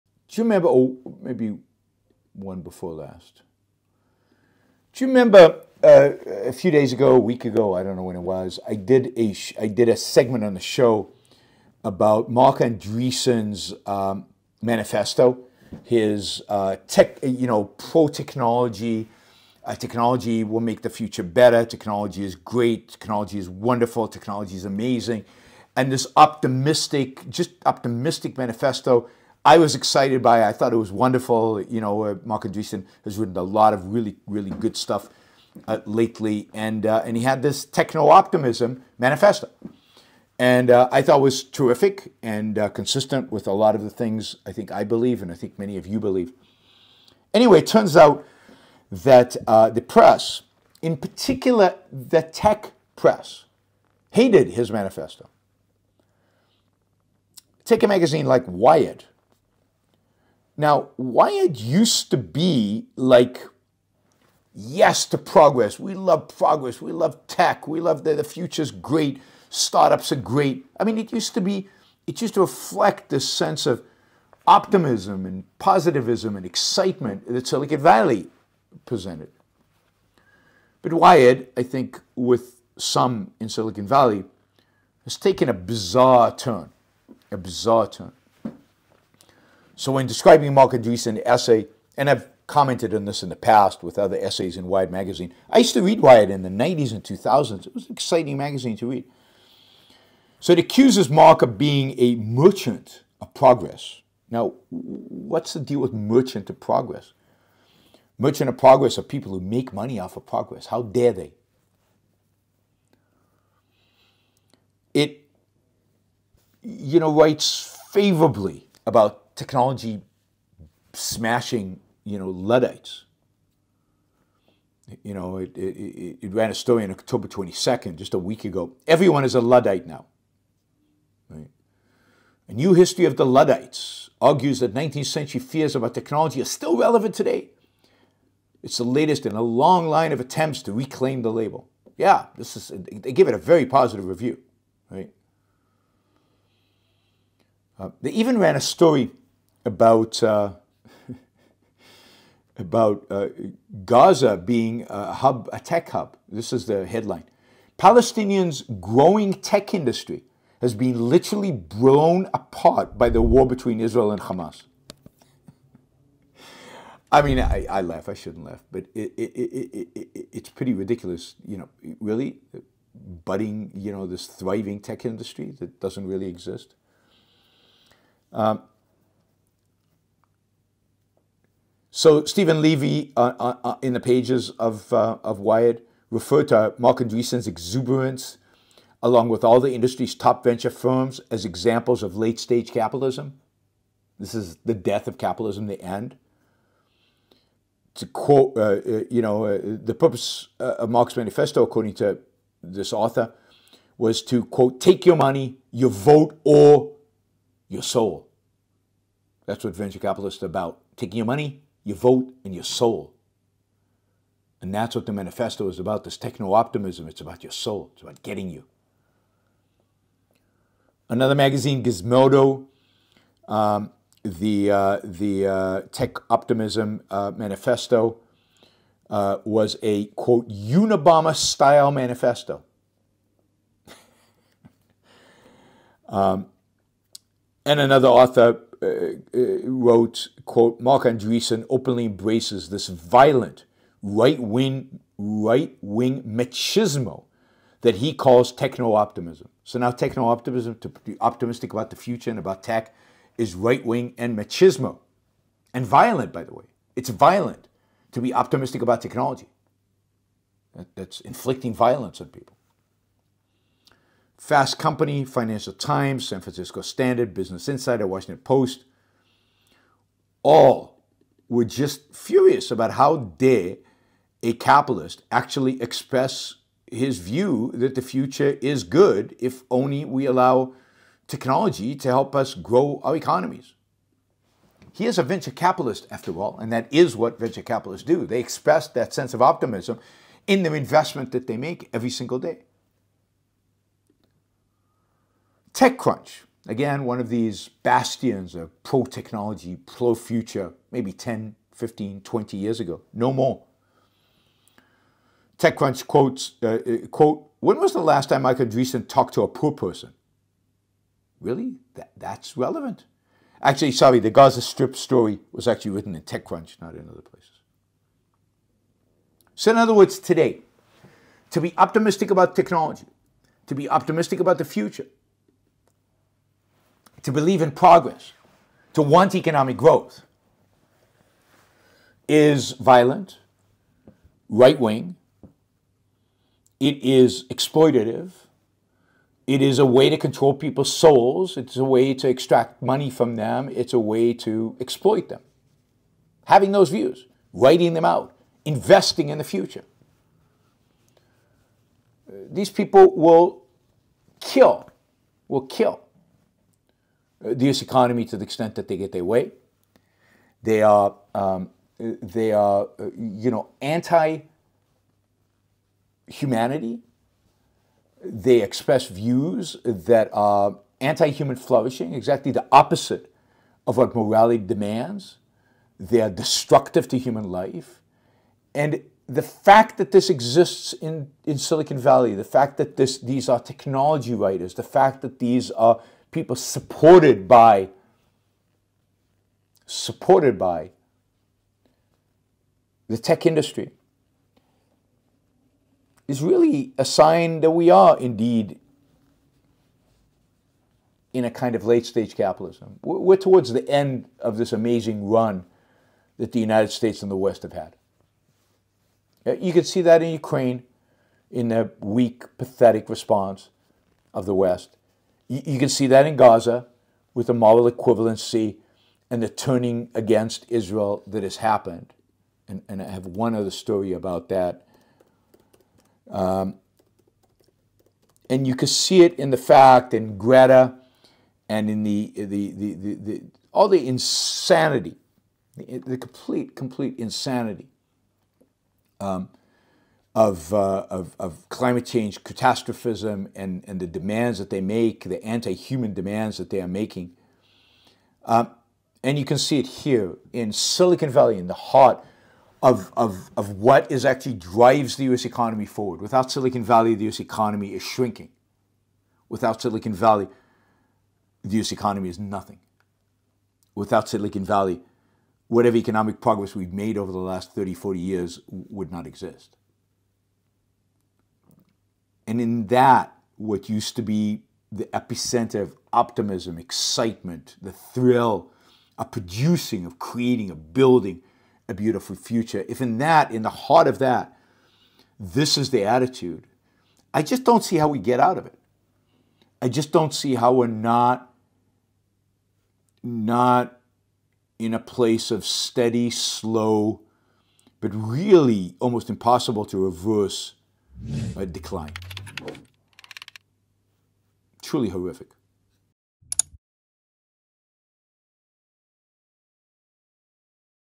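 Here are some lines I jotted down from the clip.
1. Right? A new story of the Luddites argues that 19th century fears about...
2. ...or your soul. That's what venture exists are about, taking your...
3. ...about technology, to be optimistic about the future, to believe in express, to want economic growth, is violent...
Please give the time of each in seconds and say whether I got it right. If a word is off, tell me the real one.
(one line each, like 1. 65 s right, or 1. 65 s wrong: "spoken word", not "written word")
1. 131 s wrong: "history", not "story"
2. 206 s wrong: "capitalists", not "exists"
3. 322 s wrong: "progress", not "express".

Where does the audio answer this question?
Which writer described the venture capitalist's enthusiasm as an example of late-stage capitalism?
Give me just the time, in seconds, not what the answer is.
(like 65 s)
182 s.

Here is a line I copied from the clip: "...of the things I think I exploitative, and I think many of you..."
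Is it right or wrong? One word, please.
wrong.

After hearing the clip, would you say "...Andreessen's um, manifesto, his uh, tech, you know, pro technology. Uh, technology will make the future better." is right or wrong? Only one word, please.
right.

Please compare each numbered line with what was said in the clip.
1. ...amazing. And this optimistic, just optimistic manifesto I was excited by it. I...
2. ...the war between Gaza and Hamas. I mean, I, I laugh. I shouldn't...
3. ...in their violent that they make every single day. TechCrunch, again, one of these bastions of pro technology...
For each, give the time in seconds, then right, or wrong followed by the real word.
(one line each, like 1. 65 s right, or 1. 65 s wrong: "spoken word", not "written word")
1. 24 s right
2. 163 s wrong: "Israel", not "Gaza"
3. 290 s wrong: "investment", not "violent".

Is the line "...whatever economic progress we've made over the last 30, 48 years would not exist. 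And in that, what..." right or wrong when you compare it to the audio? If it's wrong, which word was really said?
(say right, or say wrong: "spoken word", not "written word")
wrong: "40", not "48".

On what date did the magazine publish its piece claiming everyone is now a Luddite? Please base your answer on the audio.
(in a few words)
October 22.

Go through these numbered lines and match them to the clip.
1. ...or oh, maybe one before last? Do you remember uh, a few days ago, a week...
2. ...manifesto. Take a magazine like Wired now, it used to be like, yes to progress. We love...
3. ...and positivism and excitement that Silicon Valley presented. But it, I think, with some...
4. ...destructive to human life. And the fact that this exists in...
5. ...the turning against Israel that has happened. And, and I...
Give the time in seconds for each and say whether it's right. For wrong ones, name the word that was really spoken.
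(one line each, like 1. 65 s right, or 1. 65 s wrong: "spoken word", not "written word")
1. 0 s right
2. 54 s right
3. 75 s right
4. 376 s right
5. 419 s right.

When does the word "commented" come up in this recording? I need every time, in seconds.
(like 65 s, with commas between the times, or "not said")
92 s.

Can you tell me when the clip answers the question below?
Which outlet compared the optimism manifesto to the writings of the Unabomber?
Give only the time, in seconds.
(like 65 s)
221 s.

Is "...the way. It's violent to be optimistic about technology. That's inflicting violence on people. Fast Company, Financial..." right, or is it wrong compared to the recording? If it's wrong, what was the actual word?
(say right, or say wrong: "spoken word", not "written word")
right.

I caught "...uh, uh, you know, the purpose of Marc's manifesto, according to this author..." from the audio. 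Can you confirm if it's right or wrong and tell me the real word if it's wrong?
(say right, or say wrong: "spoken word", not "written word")
right.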